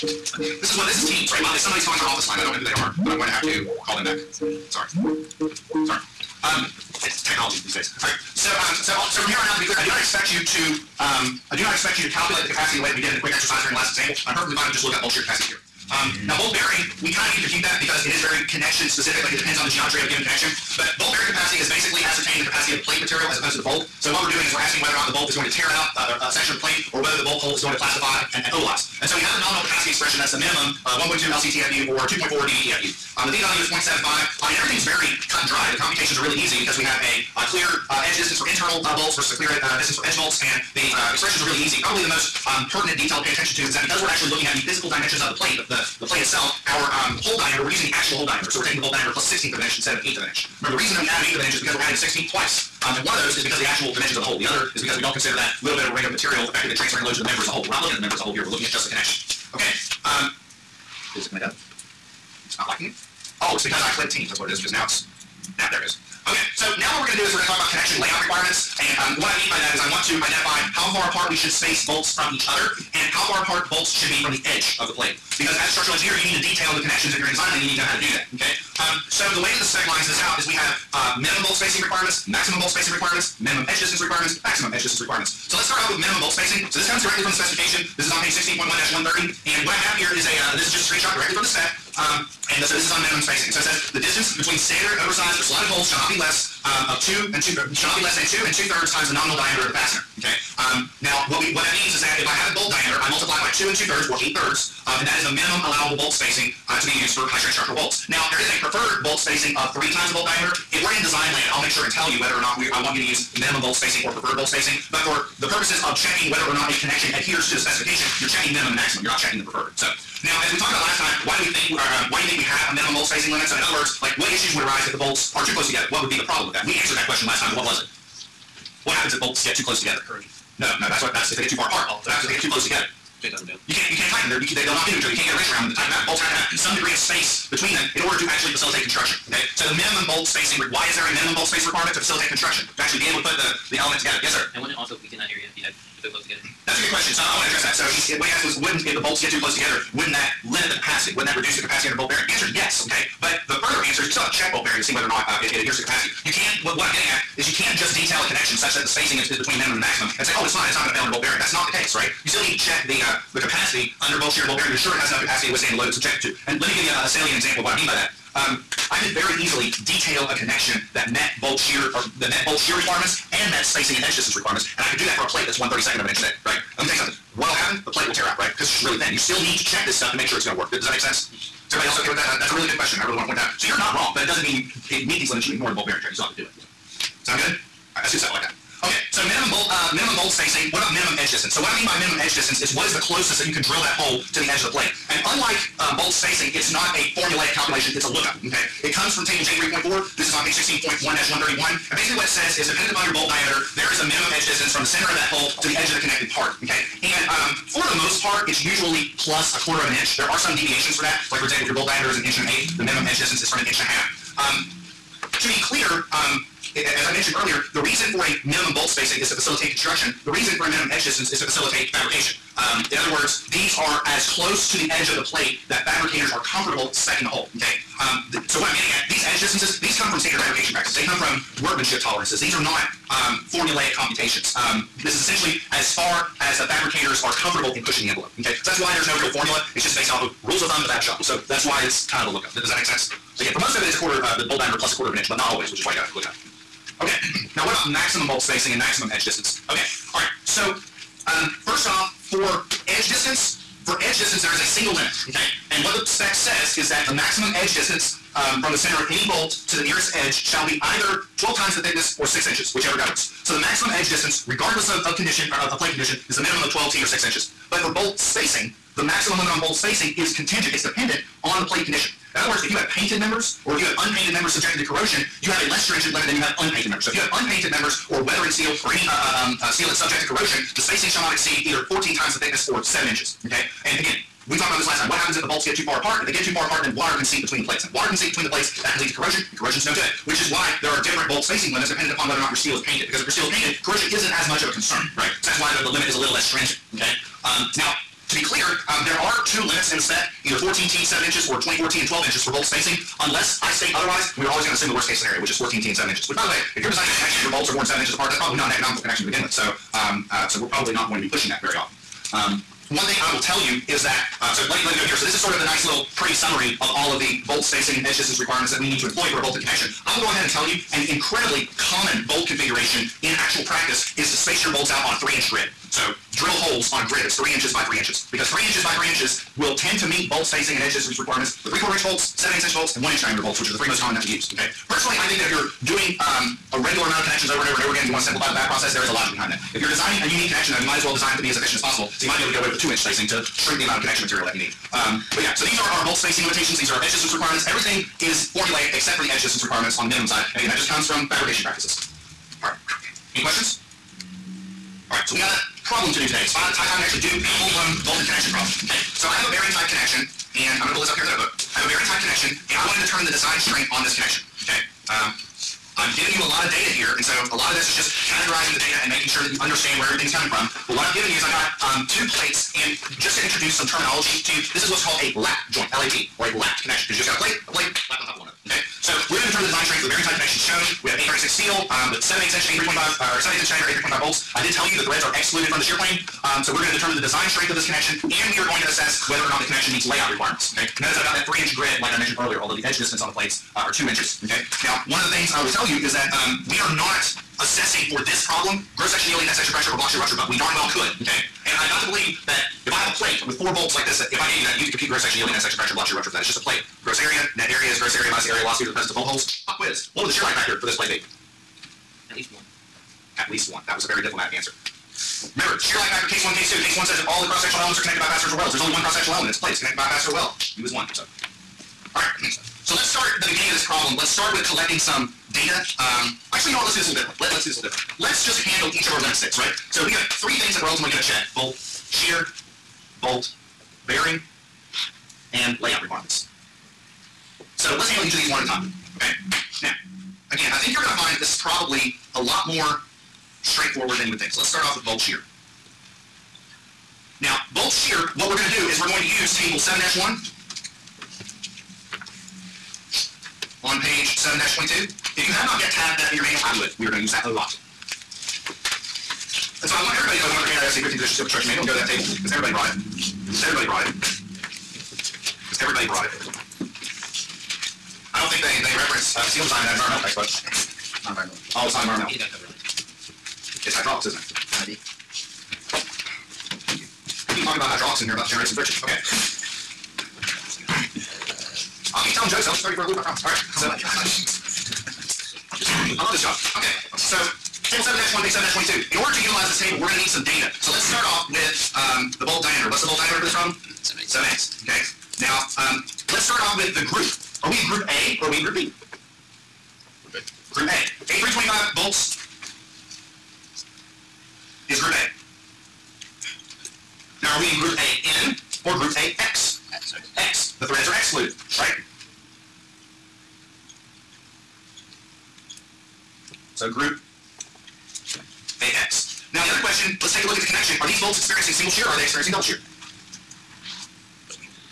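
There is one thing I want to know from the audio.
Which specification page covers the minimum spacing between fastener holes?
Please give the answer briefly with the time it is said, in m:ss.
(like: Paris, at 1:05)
16.1-130, at 1:28.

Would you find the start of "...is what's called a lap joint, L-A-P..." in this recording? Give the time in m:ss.
6:14.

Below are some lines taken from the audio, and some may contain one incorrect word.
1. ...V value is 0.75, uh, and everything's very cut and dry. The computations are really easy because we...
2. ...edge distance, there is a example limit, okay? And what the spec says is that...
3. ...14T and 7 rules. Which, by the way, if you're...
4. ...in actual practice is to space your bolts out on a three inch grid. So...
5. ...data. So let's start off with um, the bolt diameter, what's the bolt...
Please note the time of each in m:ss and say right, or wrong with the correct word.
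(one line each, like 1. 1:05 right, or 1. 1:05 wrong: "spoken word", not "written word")
1. 0:33 right
2. 4:14 wrong: "single", not "example"
3. 5:05 wrong: "inches", not "rules"
4. 5:23 right
5. 8:10 right.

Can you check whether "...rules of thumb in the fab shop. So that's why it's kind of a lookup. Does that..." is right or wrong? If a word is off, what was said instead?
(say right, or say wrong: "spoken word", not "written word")
right.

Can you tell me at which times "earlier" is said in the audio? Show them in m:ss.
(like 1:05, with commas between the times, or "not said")
3:37, 6:32.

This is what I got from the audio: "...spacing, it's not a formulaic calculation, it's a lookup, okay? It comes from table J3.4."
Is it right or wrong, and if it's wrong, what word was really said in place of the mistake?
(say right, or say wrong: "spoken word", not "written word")
right.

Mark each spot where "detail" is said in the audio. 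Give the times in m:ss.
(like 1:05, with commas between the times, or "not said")
0:42, 1:16, 2:37, 2:49.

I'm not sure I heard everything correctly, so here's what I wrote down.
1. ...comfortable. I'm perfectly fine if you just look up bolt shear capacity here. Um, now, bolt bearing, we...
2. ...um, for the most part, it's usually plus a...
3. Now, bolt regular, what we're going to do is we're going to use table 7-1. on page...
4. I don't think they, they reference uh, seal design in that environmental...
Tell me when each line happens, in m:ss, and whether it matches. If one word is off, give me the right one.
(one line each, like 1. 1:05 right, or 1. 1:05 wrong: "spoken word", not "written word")
1. 0:13 wrong: "example", not "comfortable"
2. 3:27 right
3. 7:27 wrong: "shear", not "regular"
4. 7:48 right.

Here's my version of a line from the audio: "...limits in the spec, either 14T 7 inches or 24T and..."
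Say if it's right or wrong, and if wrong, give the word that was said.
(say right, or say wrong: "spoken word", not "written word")
right.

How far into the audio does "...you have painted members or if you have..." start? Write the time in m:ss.
4:32.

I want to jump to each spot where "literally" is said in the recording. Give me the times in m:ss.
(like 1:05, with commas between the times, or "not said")
not said.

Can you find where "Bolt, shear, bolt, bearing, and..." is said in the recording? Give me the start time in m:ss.
7:11.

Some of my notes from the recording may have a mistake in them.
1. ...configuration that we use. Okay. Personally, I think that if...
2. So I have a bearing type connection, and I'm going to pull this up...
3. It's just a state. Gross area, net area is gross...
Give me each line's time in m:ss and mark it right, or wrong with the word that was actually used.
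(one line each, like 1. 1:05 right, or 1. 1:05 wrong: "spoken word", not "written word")
1. 5:34 wrong: "common", not "configuration"
2. 5:59 right
3. 6:46 wrong: "plate", not "state".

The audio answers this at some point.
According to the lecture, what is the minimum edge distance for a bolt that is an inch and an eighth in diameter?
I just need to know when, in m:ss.
3:33.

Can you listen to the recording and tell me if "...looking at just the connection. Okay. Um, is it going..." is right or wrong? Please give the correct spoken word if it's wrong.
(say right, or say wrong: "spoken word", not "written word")
right.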